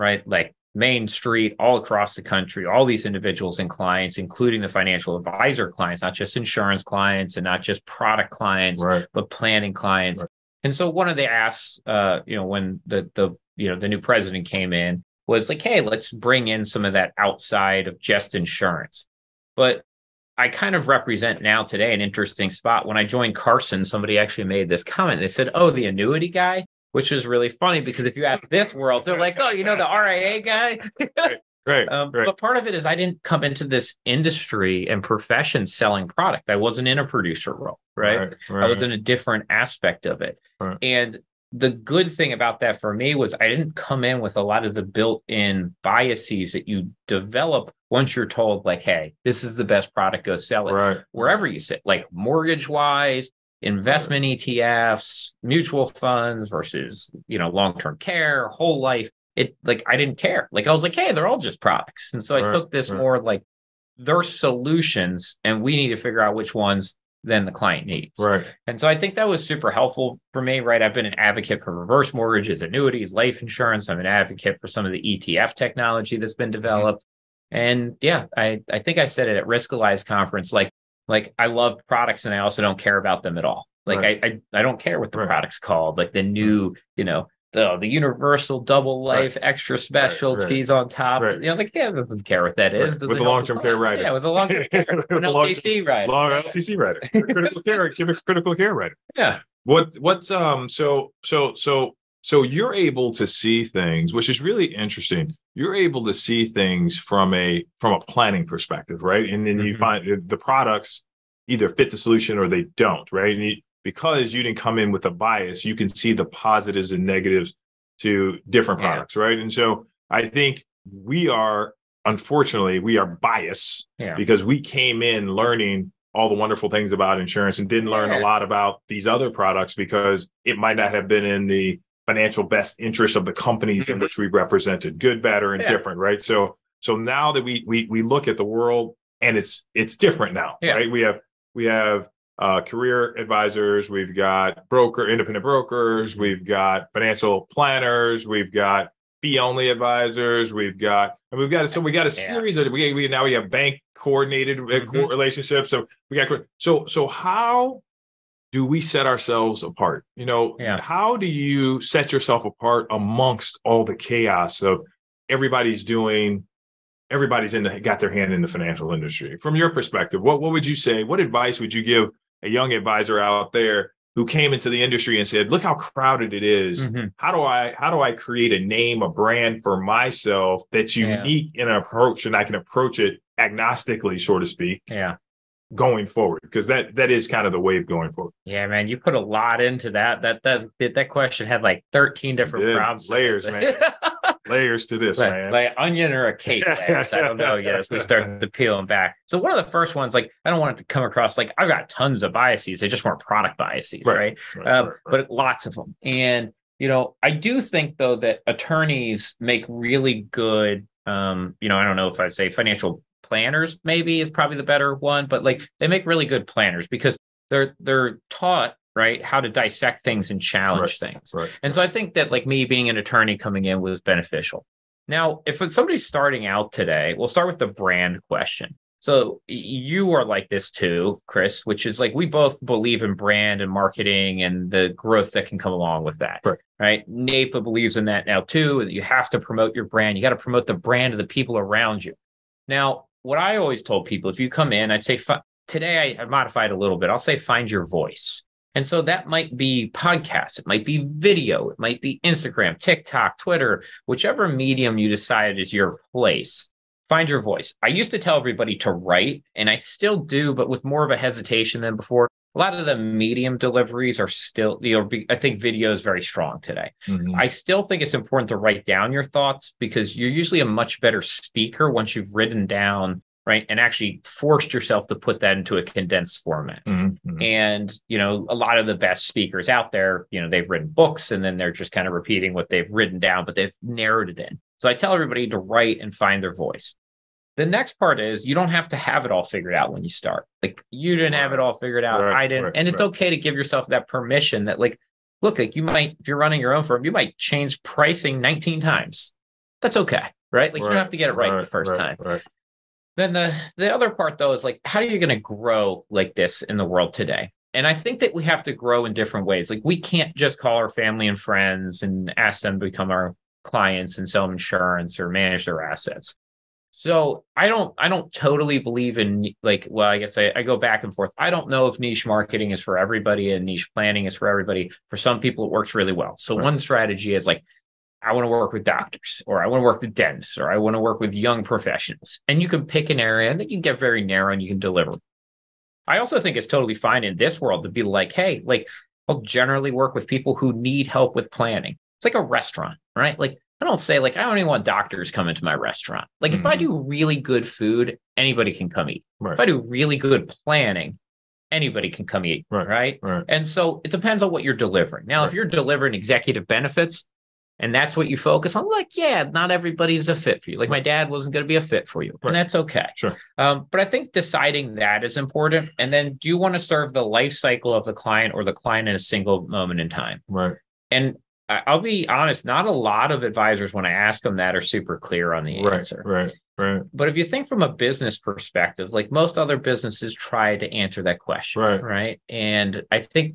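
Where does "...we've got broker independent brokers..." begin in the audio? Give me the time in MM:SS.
02:23.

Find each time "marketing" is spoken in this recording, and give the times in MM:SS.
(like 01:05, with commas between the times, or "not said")
03:53, 05:22.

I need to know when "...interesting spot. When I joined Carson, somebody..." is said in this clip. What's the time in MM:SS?
00:22.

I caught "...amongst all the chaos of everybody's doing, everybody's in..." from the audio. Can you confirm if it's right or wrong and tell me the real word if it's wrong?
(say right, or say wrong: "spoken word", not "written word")
right.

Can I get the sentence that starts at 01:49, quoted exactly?
you find uh, the products either fit the solution or they don't, right?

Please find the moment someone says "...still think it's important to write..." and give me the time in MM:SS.
04:27.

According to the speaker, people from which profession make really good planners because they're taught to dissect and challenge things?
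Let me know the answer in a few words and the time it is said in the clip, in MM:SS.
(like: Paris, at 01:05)
Attorneys, at 03:28.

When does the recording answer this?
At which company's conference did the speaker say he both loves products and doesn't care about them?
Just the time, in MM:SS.
01:19.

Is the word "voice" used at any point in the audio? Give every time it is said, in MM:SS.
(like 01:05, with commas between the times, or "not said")
04:07, 04:17, 04:46.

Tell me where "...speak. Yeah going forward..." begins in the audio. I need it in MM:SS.
03:04.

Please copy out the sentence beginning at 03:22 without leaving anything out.
They just weren't product biases, right?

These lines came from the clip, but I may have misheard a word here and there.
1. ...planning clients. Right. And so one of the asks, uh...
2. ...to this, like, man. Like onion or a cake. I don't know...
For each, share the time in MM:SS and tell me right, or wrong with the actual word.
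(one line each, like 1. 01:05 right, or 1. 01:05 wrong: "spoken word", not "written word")
1. 00:09 right
2. 03:14 right.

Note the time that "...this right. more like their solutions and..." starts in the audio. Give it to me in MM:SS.
01:02.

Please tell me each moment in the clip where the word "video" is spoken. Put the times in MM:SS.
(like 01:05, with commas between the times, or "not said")
04:11, 04:25.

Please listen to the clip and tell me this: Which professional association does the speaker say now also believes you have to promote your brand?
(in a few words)
NAIFA.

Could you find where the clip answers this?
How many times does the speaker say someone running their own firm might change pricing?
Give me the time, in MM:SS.
04:58.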